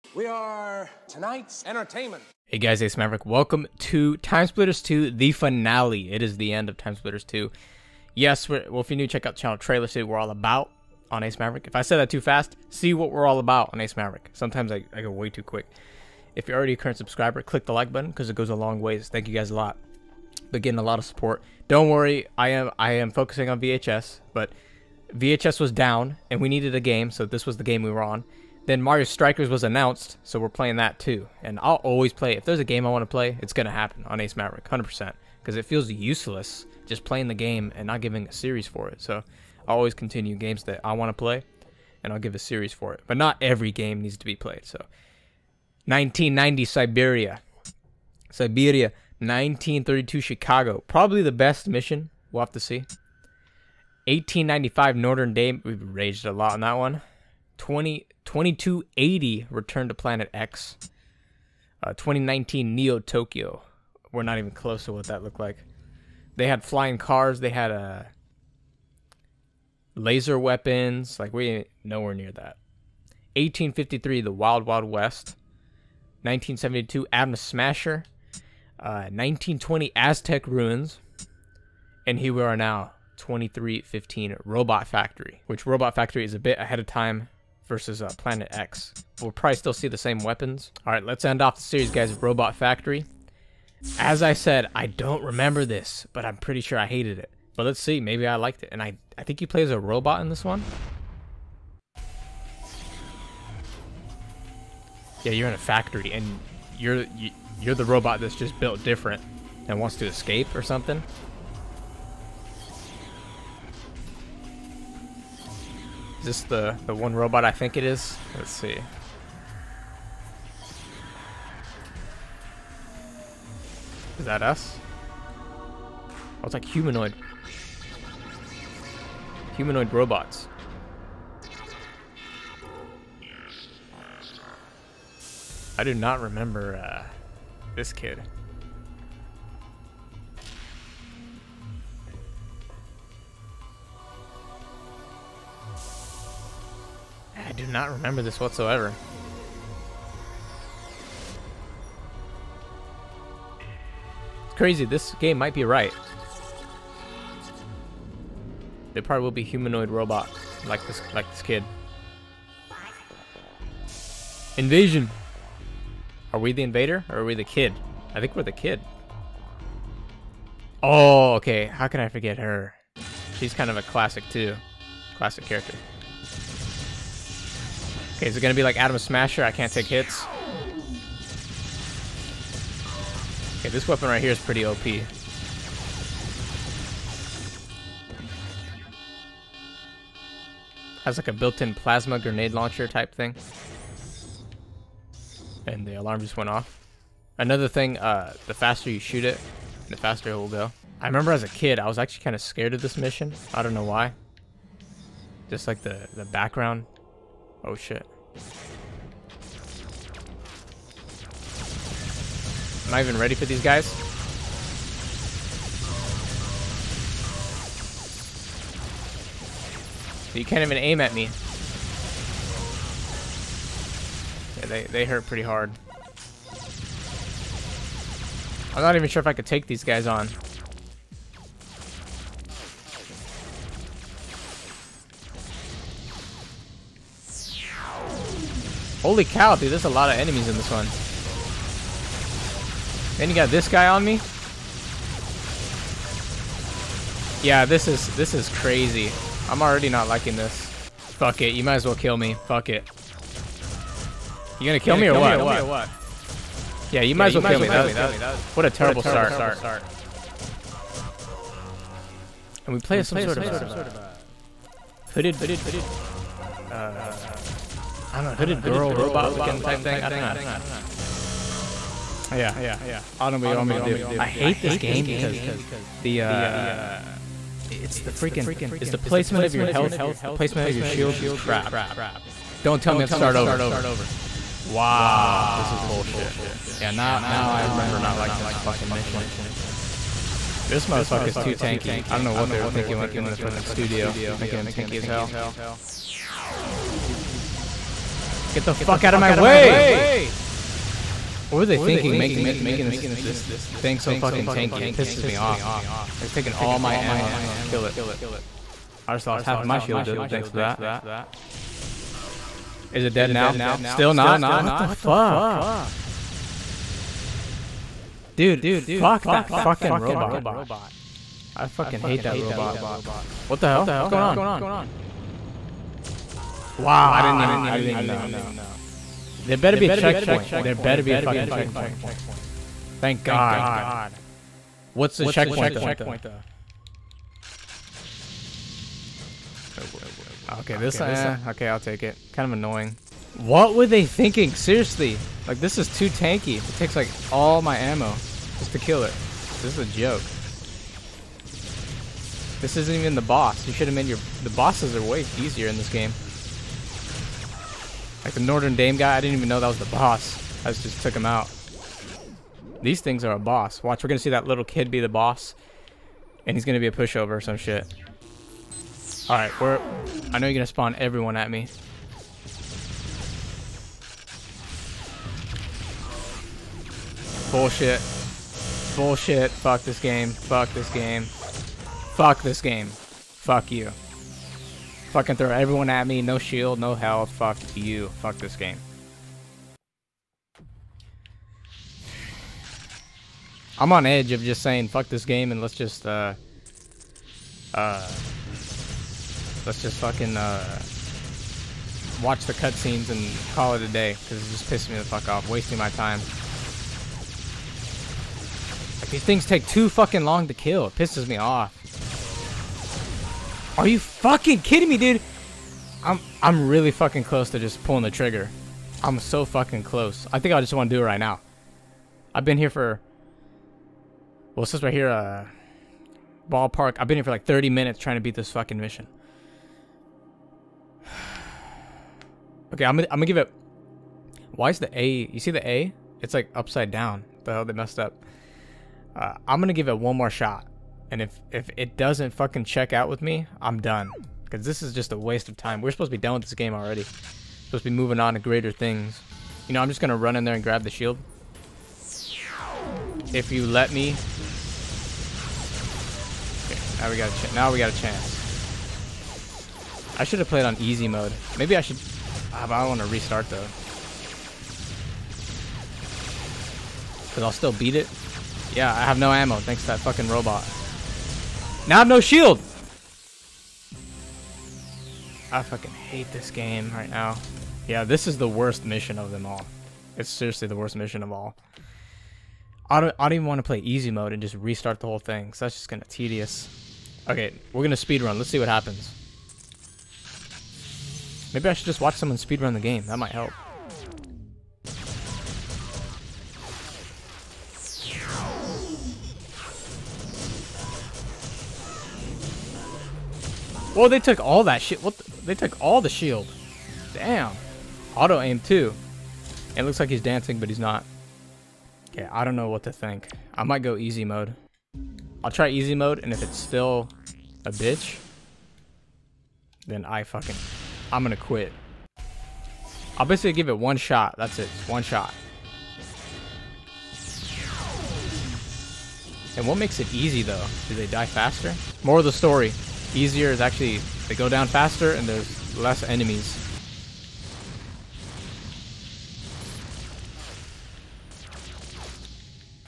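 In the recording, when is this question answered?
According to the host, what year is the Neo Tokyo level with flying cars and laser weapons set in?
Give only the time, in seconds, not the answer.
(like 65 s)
61 s.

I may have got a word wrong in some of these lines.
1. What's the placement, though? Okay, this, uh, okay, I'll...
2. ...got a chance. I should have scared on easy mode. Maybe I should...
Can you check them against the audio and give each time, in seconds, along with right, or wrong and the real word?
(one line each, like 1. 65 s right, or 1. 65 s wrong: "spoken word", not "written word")
1. 334 s wrong: "checkpoint", not "placement"
2. 457 s wrong: "played", not "scared".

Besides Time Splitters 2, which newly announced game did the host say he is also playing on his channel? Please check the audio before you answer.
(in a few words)
Mario Strikers.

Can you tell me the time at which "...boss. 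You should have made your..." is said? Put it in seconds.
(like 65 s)
353 s.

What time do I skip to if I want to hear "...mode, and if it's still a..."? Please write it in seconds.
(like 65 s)
515 s.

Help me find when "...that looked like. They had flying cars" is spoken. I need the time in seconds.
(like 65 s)
65 s.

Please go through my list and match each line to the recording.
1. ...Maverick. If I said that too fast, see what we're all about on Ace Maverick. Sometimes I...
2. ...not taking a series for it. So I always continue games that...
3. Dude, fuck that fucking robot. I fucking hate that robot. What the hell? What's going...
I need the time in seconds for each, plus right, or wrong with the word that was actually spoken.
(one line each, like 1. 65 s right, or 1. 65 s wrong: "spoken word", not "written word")
1. 11 s right
2. 37 s wrong: "giving", not "taking"
3. 318 s right.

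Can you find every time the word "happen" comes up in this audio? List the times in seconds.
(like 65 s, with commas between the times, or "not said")
33 s, 488 s.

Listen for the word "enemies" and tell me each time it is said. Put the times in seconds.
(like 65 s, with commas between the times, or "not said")
240 s, 536 s.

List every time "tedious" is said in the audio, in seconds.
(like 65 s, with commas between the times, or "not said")
486 s.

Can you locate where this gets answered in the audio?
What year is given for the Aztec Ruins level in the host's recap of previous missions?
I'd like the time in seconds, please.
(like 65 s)
79 s.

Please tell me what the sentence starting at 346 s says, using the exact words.
It takes, like, all my ammo just to kill it.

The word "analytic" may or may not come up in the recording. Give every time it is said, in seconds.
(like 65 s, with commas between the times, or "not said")
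not said.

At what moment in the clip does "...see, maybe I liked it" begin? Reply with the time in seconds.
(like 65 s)
97 s.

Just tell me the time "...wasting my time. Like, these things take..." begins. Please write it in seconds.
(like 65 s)
405 s.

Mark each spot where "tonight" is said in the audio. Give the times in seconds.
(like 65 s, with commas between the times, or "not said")
1 s.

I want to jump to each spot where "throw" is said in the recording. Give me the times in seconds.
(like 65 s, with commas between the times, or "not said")
385 s.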